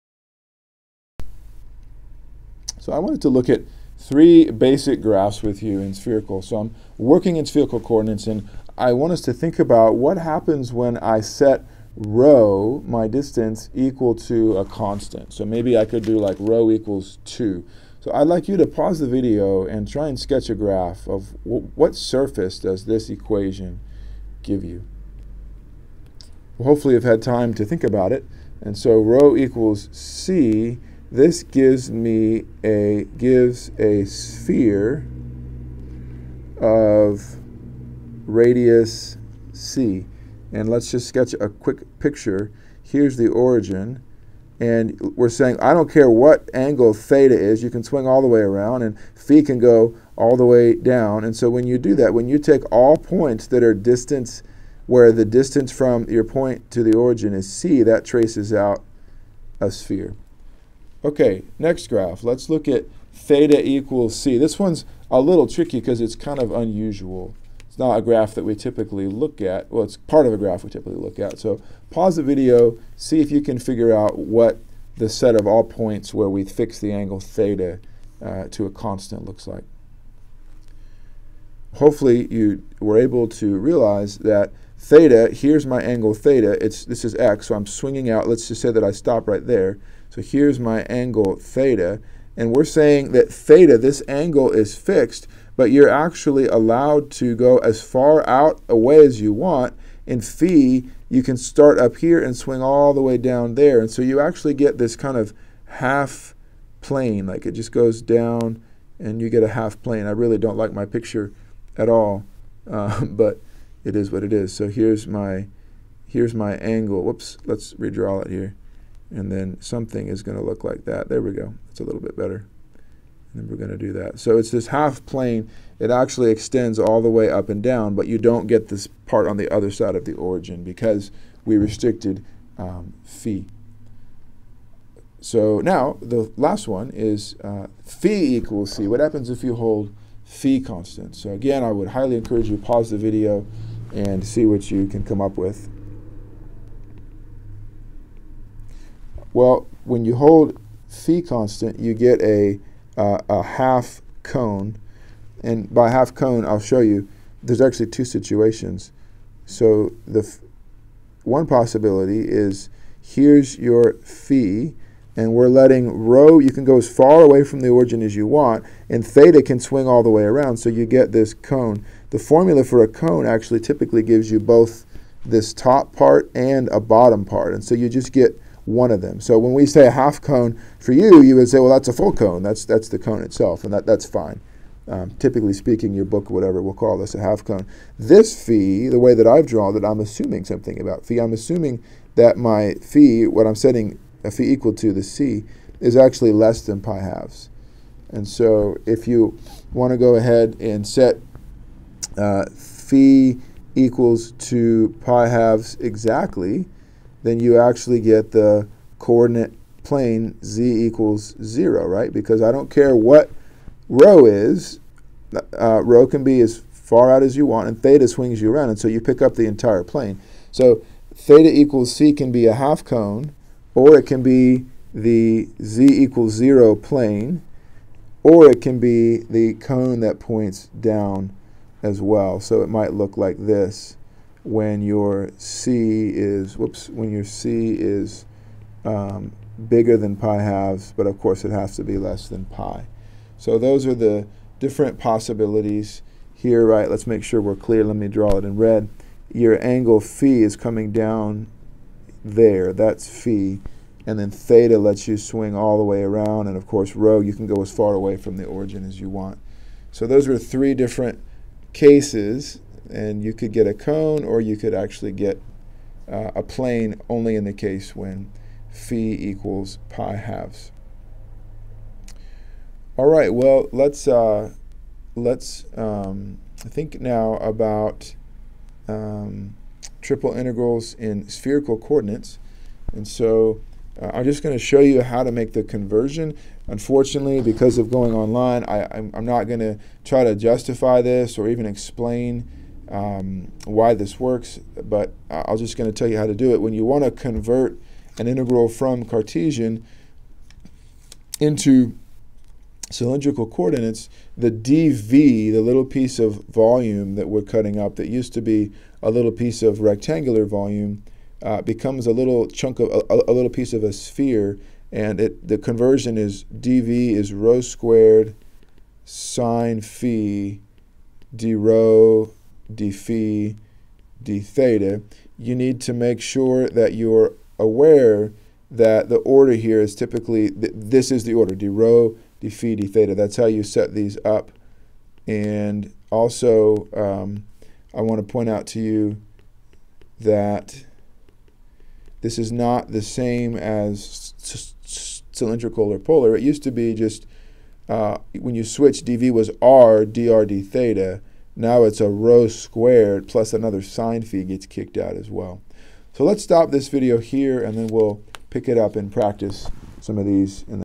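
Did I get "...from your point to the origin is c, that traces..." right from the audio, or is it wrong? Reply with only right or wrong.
right.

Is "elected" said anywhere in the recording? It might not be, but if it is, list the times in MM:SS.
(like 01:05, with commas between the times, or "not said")
not said.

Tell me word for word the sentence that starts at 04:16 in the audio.
And of course, rho, you can go as far away from the origin as you want.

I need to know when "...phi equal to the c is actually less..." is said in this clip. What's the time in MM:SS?
03:14.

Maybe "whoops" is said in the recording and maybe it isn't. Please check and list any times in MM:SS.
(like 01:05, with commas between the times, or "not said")
01:57, 03:56.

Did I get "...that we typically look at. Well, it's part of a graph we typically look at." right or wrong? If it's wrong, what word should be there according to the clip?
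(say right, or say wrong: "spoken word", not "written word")
right.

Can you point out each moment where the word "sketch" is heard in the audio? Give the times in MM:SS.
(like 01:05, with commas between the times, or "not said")
00:20, 00:41.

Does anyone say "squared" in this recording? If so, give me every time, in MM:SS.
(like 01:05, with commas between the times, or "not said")
05:17, 05:52.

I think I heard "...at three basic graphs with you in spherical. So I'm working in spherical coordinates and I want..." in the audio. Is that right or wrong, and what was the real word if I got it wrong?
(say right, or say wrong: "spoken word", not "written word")
right.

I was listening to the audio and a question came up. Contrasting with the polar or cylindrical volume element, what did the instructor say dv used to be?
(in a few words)
r dr d theta.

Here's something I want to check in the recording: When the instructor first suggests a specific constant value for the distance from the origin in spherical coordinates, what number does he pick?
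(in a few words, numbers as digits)
2.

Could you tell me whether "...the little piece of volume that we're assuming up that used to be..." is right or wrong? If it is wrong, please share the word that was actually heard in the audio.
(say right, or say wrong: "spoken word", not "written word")
wrong: "cutting", not "assuming".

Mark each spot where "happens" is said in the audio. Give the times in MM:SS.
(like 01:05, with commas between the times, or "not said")
00:10, 02:18.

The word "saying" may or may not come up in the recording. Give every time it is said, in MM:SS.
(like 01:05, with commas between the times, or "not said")
00:45, 01:32.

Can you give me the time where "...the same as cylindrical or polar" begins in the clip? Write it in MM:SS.
05:42.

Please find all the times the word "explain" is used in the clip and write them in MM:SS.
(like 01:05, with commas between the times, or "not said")
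04:51.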